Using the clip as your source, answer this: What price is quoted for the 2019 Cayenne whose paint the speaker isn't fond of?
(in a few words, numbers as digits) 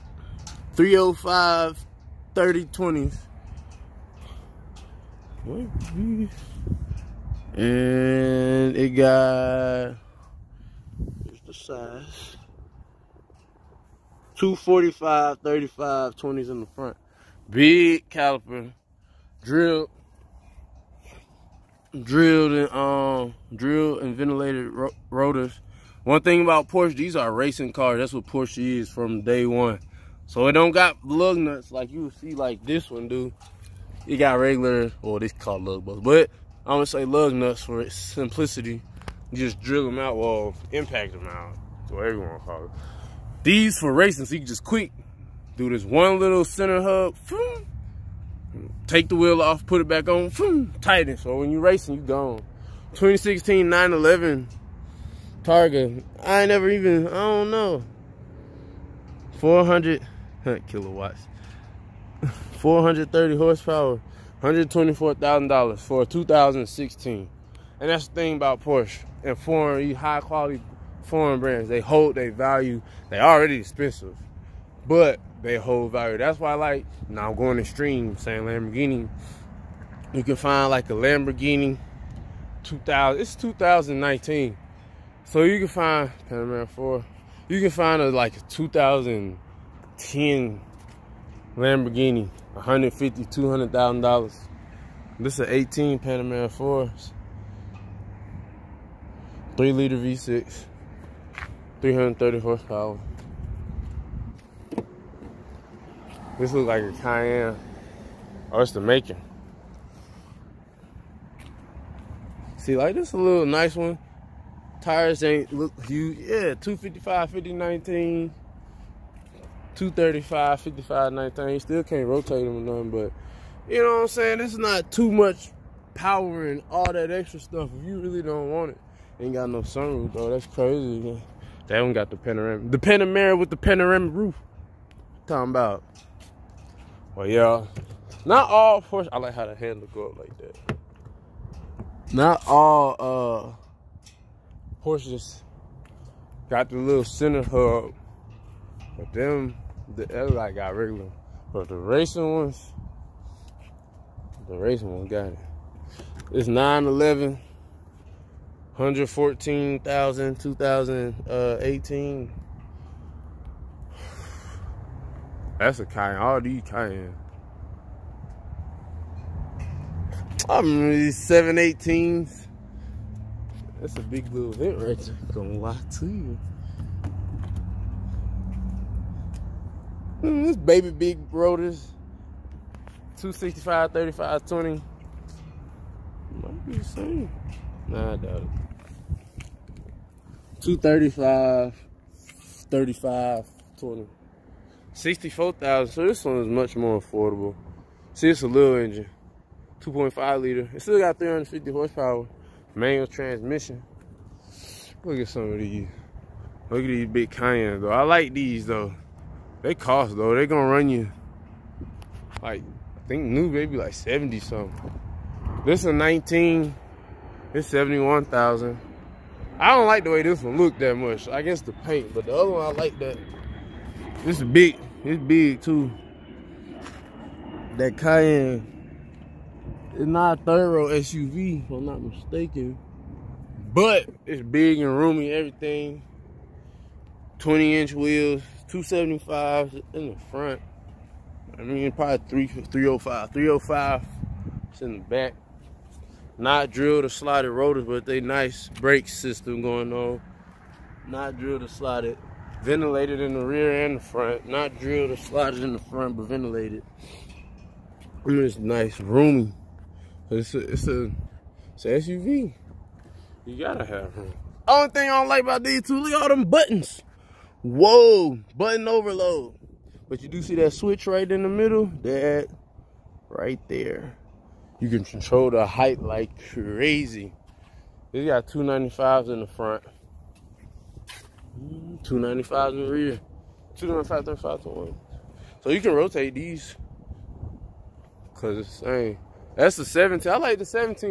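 $71,000.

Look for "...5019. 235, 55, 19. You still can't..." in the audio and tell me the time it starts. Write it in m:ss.
1:57.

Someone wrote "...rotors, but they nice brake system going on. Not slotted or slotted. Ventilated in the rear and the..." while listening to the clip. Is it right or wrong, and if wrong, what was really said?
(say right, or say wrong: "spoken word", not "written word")
wrong: "drilled", not "slotted".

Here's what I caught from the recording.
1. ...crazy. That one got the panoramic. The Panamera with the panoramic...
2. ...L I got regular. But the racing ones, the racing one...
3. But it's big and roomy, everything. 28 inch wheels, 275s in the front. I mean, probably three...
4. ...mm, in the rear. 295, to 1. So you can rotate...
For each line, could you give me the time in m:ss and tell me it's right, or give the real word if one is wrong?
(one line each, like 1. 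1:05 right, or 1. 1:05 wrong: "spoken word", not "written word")
1. 2:10 right
2. 2:30 right
3. 3:53 wrong: "20", not "28"
4. 4:42 right.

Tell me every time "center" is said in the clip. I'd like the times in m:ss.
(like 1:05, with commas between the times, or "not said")
0:46, 2:27.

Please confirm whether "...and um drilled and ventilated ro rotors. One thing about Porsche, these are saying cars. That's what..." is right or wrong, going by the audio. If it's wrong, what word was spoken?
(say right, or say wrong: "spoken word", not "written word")
wrong: "racing", not "saying".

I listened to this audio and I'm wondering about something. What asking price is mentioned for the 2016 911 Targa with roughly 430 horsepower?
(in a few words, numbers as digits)
$124,000.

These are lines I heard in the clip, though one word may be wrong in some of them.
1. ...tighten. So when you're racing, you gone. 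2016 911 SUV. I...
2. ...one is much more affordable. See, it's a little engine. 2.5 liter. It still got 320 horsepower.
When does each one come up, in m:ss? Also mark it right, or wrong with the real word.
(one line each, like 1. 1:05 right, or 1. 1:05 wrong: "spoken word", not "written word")
1. 0:50 wrong: "Targa", not "SUV"
2. 3:16 wrong: "350", not "320".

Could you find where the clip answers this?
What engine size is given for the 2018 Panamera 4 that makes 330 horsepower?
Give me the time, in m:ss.
1:39.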